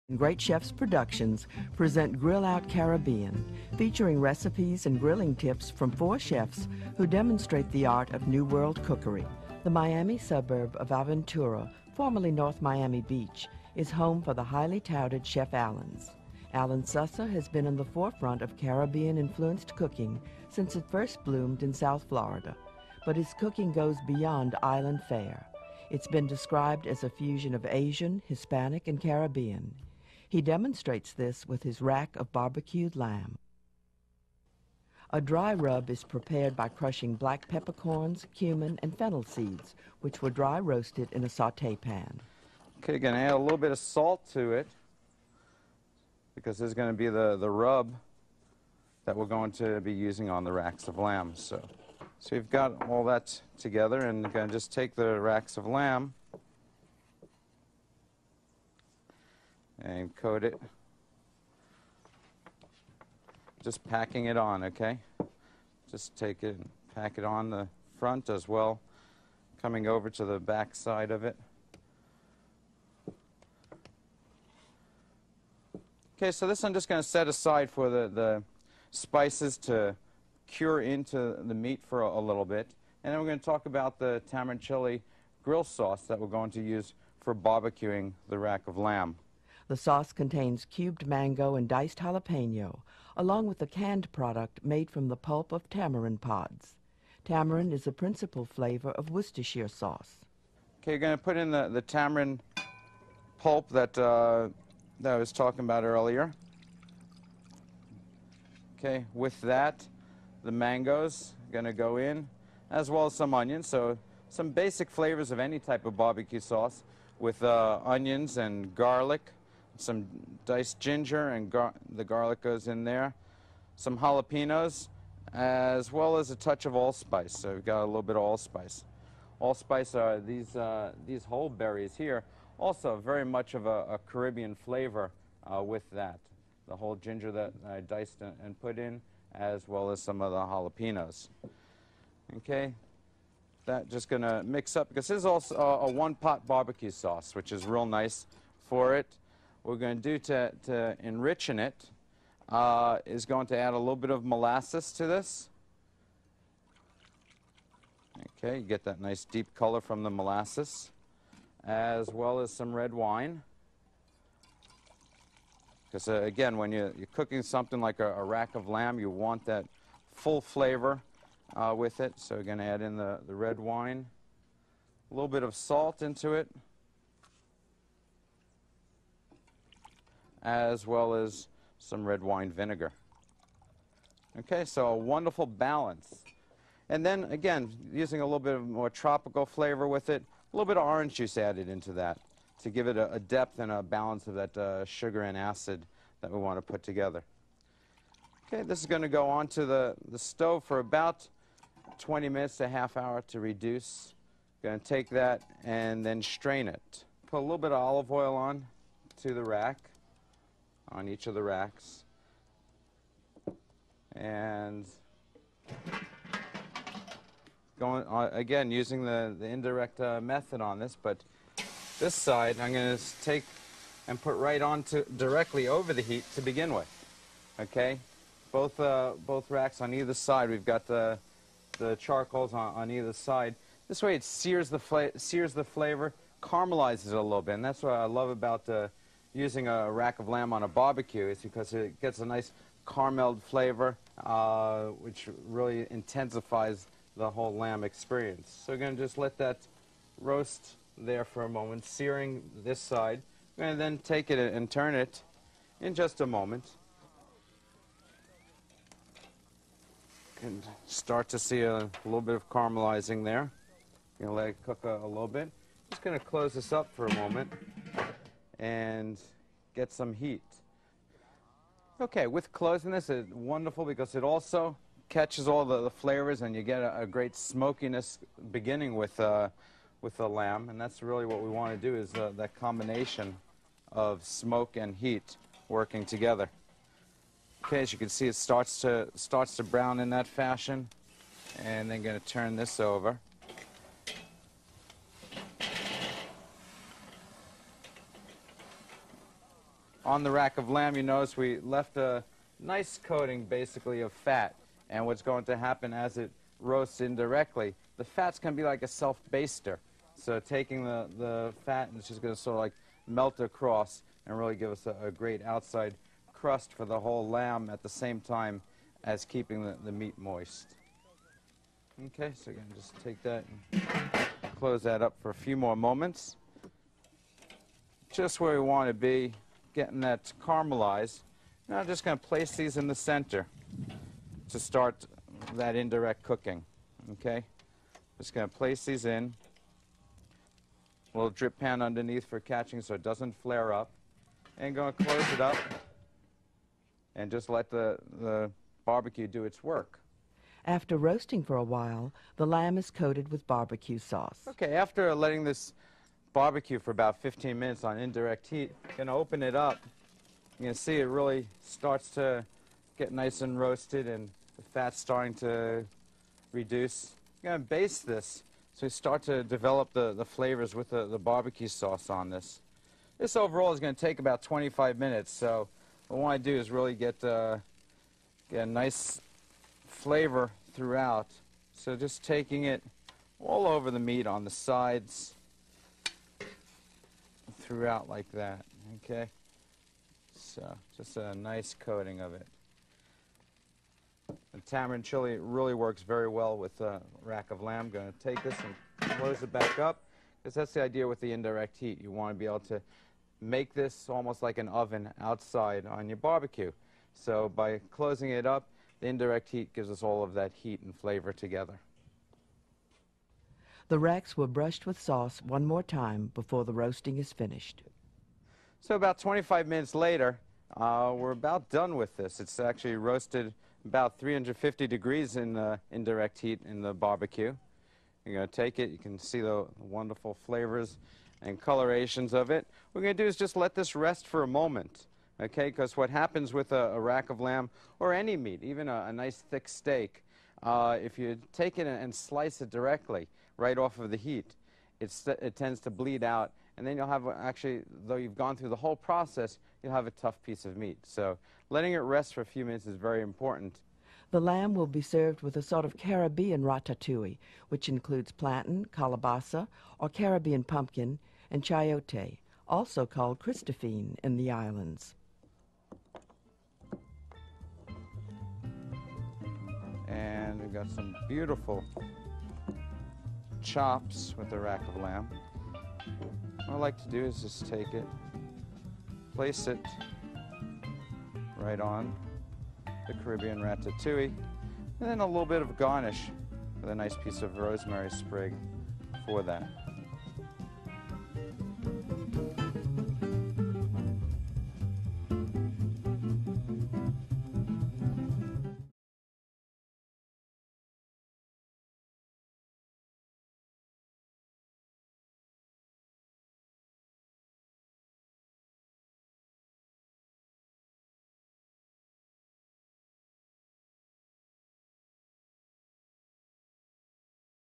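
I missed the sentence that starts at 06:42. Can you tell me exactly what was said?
You want to be able to make this almost like an oven outside on your barbecue.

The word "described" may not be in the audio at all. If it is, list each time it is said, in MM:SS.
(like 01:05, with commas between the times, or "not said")
00:26.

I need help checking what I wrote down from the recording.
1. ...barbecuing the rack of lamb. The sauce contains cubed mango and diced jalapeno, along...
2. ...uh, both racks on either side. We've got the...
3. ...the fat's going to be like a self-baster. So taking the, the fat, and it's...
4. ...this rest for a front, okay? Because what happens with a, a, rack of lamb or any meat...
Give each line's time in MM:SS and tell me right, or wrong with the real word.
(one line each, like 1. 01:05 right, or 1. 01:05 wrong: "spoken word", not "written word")
1. 01:27 right
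2. 03:48 right
3. 05:07 right
4. 07:13 wrong: "moment", not "front".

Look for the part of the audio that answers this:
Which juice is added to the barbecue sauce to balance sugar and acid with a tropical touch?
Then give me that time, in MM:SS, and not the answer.
03:10.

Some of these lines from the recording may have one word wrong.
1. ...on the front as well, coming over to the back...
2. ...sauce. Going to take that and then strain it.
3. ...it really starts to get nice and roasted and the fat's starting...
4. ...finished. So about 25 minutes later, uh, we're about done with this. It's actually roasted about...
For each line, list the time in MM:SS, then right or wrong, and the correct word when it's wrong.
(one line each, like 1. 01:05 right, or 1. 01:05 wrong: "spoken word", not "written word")
1. 01:07 right
2. 03:23 wrong: "reduce", not "sauce"
3. 06:00 right
4. 06:57 right.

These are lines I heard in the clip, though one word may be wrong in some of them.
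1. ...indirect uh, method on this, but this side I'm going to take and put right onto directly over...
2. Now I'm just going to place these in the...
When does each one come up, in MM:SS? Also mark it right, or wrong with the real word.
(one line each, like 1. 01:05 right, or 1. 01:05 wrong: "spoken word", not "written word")
1. 03:39 right
2. 05:31 right.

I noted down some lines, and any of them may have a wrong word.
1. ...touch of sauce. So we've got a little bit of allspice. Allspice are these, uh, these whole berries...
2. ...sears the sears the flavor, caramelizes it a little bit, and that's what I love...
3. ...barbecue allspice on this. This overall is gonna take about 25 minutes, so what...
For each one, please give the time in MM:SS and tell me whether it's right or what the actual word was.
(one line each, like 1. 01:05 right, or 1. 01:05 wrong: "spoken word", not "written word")
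1. 02:06 wrong: "allspice", not "sauce"
2. 03:54 right
3. 06:11 wrong: "sauce", not "allspice".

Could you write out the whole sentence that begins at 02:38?
Okay, you get that nice deep color from the molasses, as well as some red wine.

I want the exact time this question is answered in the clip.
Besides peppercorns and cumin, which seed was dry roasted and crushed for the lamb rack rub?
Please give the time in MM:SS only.
00:38.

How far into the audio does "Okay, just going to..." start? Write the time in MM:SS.
05:37.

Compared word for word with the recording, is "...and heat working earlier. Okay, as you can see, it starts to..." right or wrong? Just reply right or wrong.
wrong.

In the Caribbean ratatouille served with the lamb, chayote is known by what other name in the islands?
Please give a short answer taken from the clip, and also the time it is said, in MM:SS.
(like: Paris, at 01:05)
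Christophine, at 07:43.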